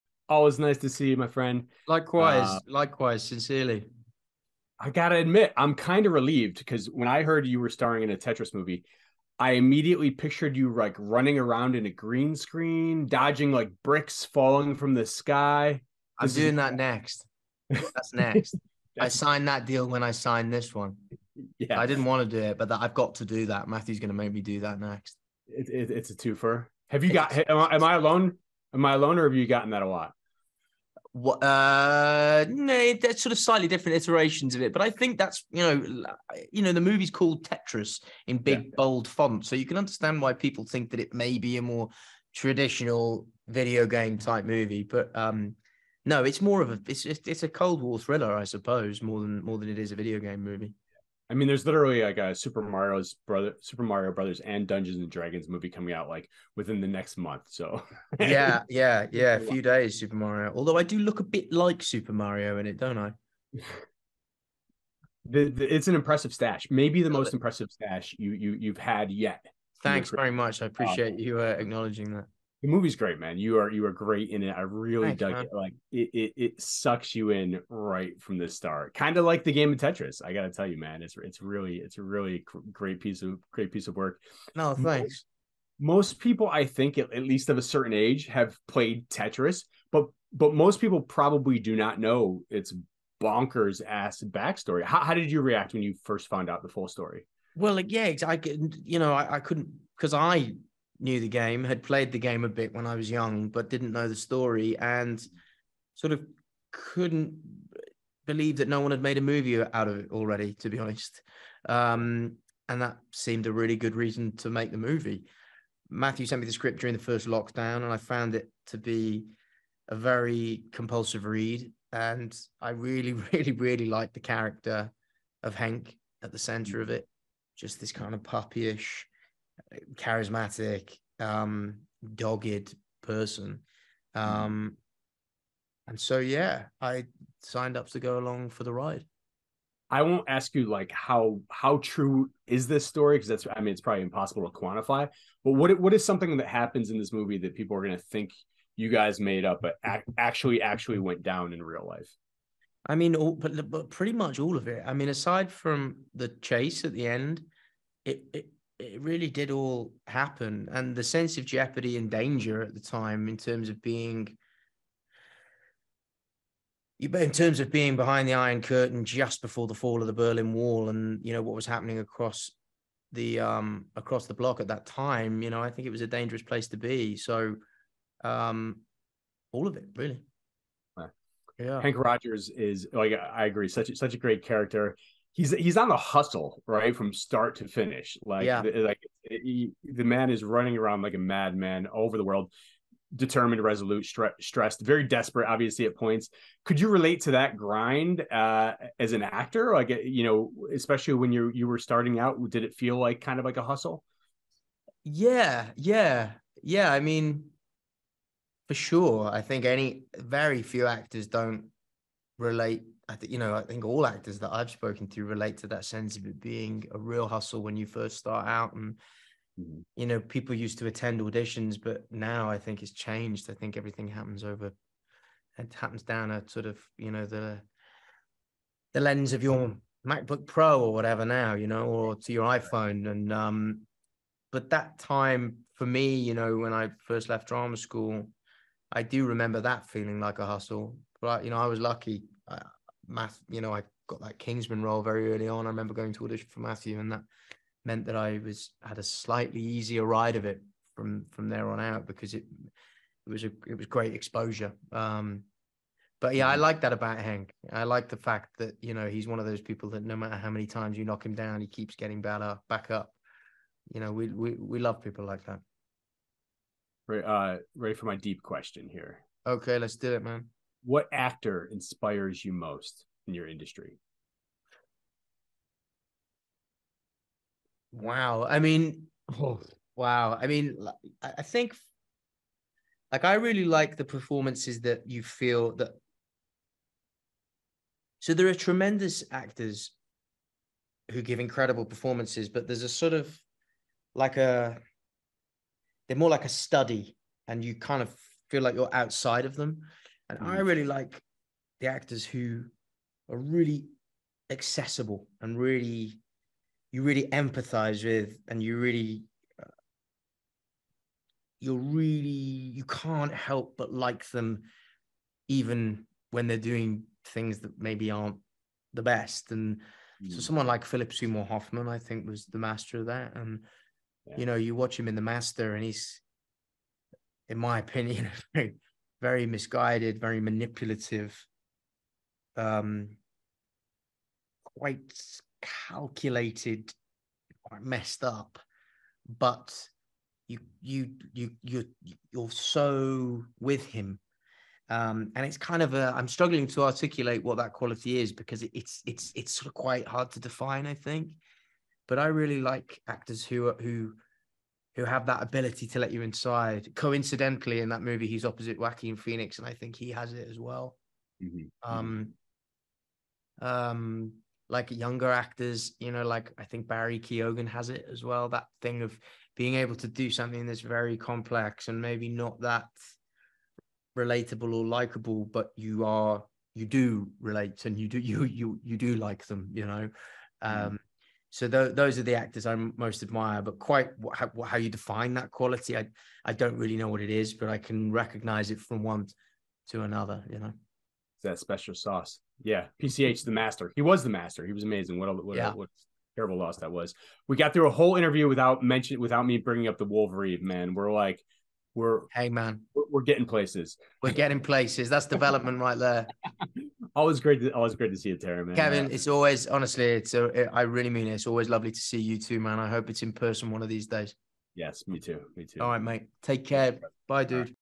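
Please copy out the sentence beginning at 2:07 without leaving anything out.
Just this kind of puppyish, charismatic, um, dogged person.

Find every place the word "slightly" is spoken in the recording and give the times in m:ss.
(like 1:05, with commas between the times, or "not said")
0:33, 4:09.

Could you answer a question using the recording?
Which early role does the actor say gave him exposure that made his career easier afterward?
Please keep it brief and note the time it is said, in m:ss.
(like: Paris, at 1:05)
Kingsman, at 4:04.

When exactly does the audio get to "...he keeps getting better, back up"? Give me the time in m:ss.
4:21.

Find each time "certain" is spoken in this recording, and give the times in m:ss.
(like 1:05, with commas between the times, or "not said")
1:27.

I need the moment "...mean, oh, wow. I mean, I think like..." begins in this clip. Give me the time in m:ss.
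4:38.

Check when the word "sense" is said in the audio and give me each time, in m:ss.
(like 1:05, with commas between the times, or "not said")
2:41, 3:35.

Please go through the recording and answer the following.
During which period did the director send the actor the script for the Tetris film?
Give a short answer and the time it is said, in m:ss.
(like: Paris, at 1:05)
The first lockdown, at 1:57.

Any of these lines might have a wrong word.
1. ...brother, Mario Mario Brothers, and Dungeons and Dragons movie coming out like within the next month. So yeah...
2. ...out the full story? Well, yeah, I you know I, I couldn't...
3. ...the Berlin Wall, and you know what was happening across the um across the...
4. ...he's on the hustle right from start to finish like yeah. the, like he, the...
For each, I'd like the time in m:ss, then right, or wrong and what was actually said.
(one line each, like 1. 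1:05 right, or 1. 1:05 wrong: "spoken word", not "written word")
1. 0:53 wrong: "Super", not "Mario"
2. 1:36 right
3. 2:50 right
4. 3:05 right.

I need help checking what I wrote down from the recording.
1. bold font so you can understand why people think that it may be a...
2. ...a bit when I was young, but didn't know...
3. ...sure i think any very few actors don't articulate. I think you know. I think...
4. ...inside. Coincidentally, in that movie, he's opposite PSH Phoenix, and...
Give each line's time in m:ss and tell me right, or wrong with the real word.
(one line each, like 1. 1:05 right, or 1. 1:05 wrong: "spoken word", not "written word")
1. 0:38 right
2. 1:42 right
3. 3:28 wrong: "relate", not "articulate"
4. 5:56 wrong: "Joaquin", not "PSH".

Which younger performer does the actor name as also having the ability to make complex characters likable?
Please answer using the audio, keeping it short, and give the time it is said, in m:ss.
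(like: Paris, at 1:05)
Barry Keoghan, at 6:06.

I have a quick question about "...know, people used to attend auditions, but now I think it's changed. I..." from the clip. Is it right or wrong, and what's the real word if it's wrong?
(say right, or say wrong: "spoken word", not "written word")
right.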